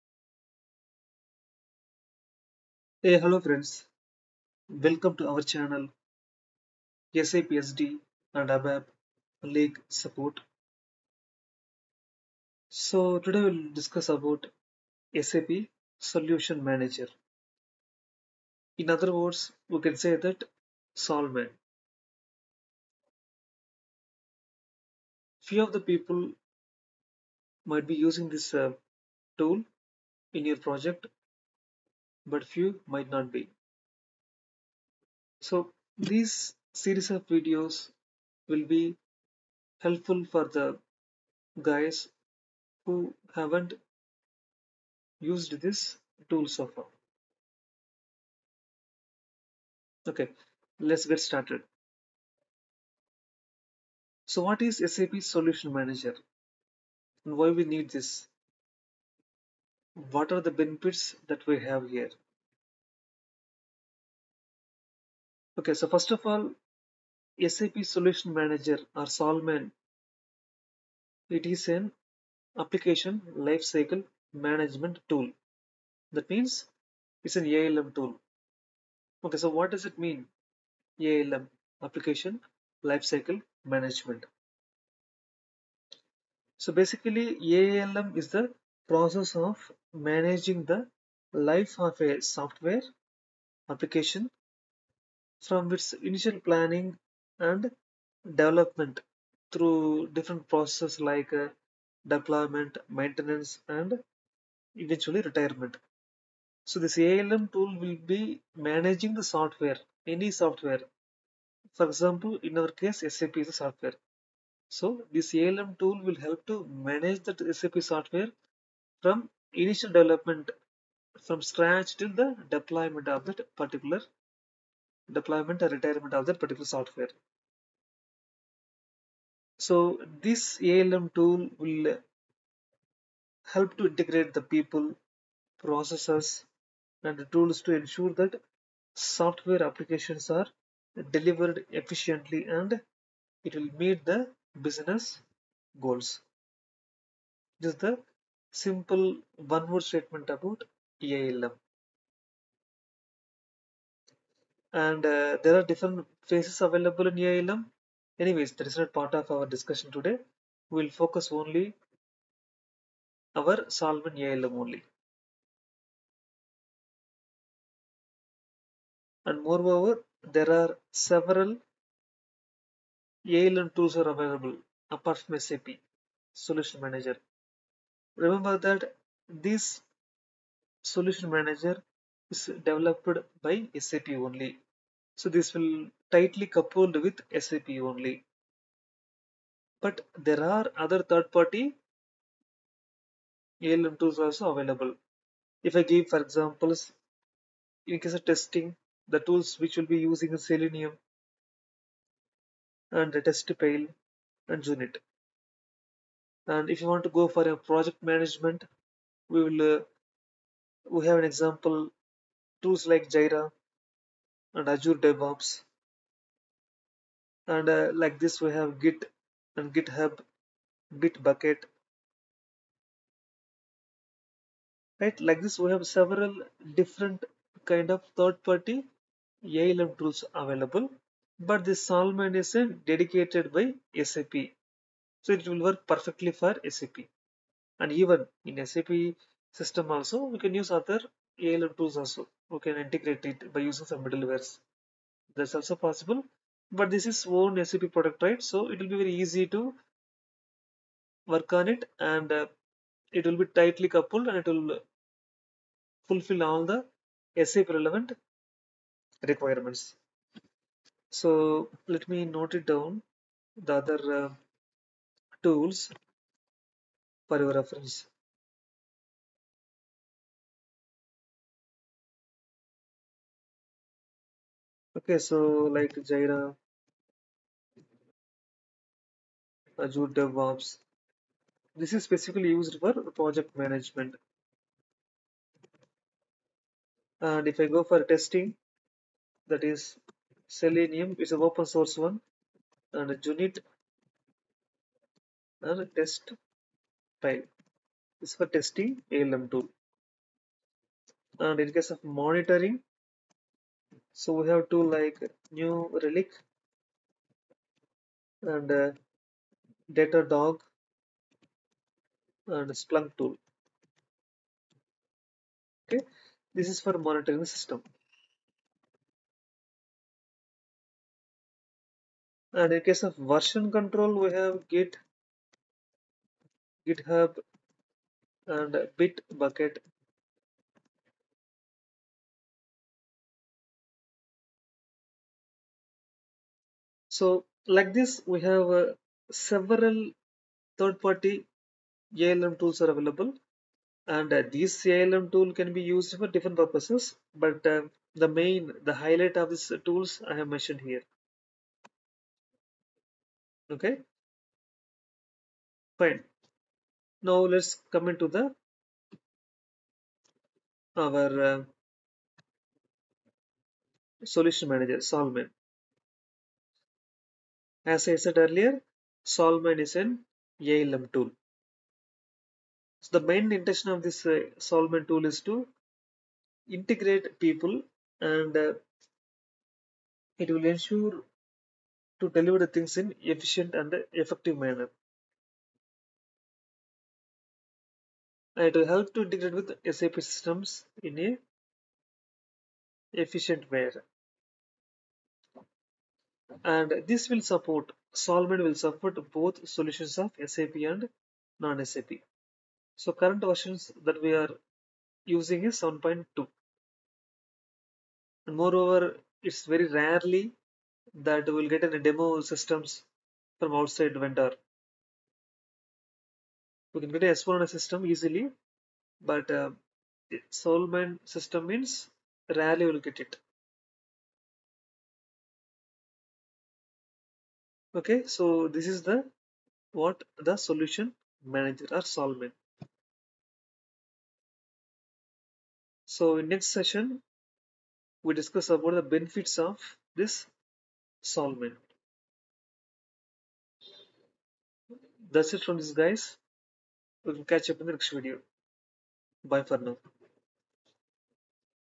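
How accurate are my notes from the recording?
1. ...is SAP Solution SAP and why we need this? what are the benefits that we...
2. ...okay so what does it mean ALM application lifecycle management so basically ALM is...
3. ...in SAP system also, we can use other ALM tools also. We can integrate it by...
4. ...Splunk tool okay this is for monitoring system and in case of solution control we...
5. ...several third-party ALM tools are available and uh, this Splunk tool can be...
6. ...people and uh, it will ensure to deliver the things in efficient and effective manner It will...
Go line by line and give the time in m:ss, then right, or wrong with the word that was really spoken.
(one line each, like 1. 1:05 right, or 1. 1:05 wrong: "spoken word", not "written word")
1. 0:54 wrong: "Manager", not "SAP"
2. 1:19 right
3. 3:58 right
4. 5:12 wrong: "version", not "solution"
5. 5:39 wrong: "ALM", not "Splunk"
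6. 6:17 right.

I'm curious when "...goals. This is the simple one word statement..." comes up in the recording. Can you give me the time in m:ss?
2:25.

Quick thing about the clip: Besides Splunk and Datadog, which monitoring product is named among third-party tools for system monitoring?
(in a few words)
New Relic.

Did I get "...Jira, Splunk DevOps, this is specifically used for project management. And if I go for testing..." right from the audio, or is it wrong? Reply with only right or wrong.
wrong.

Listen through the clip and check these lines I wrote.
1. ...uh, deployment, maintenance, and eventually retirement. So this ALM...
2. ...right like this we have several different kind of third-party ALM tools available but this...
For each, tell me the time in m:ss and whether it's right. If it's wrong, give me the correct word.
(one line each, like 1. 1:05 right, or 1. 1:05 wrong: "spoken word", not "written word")
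1. 1:41 right
2. 3:44 right.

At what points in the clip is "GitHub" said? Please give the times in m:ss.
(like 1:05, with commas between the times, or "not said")
3:39, 5:26.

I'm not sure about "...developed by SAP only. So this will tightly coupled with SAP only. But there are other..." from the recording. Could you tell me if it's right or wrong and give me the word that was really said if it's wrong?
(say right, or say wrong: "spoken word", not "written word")
right.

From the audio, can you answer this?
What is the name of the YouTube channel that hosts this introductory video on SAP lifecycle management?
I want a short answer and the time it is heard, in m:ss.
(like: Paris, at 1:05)
SAPSD and ABAP League Support, at 0:07.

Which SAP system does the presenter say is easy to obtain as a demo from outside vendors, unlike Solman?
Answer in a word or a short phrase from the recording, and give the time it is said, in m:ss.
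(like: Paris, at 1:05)
S/4HANA, at 6:57.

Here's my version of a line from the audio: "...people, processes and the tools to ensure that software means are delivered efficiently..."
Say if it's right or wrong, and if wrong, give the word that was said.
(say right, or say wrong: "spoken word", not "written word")
wrong: "applications", not "means".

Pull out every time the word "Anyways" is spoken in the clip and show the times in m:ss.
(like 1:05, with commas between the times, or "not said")
2:38.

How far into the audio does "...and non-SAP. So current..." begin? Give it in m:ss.
6:40.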